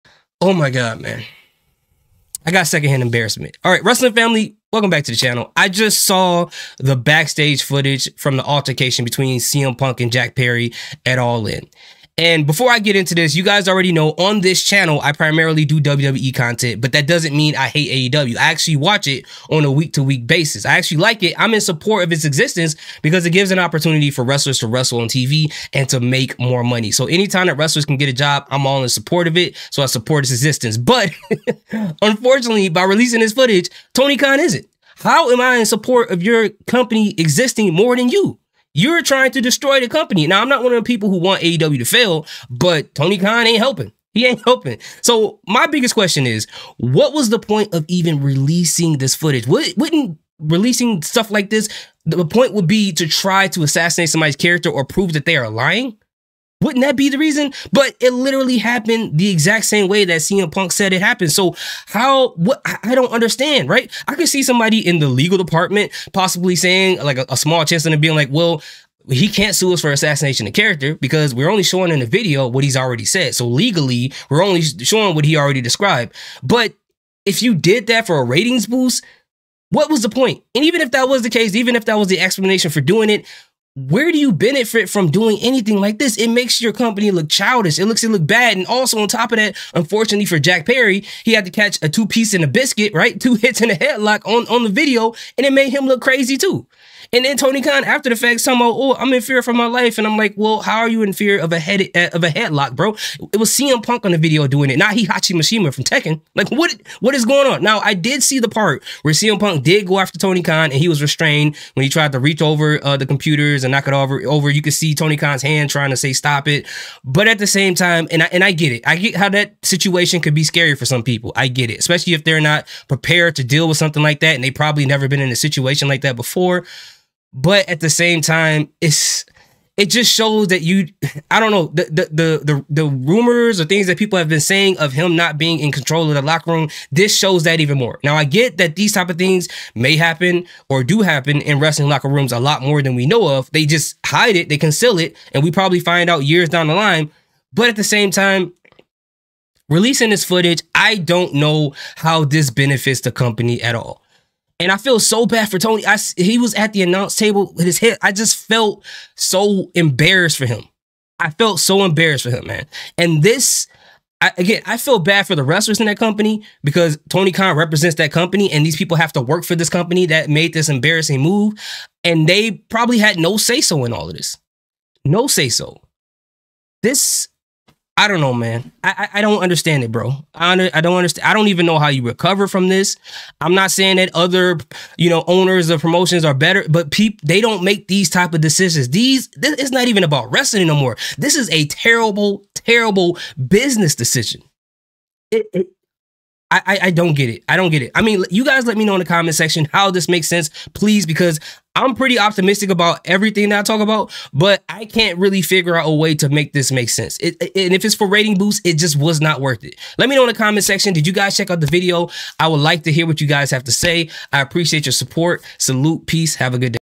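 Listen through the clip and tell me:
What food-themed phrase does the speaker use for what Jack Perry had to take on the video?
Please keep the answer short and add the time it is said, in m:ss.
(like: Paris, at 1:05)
A two piece and a biscuit, at 1:31.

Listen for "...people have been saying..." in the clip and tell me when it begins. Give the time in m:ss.
2:13.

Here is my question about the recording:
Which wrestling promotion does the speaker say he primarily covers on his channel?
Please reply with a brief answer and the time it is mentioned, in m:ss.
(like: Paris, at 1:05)
WWE, at 0:15.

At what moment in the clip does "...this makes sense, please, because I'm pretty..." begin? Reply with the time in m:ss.
3:19.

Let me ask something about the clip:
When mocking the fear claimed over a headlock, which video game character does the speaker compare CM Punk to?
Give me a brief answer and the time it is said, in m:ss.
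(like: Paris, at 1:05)
Heihachi Mishima, at 1:44.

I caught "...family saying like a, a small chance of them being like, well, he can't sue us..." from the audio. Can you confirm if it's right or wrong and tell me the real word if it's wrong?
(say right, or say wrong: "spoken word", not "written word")
wrong: "possibly", not "family".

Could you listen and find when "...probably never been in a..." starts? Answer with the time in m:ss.
2:04.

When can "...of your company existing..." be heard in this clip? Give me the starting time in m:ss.
0:36.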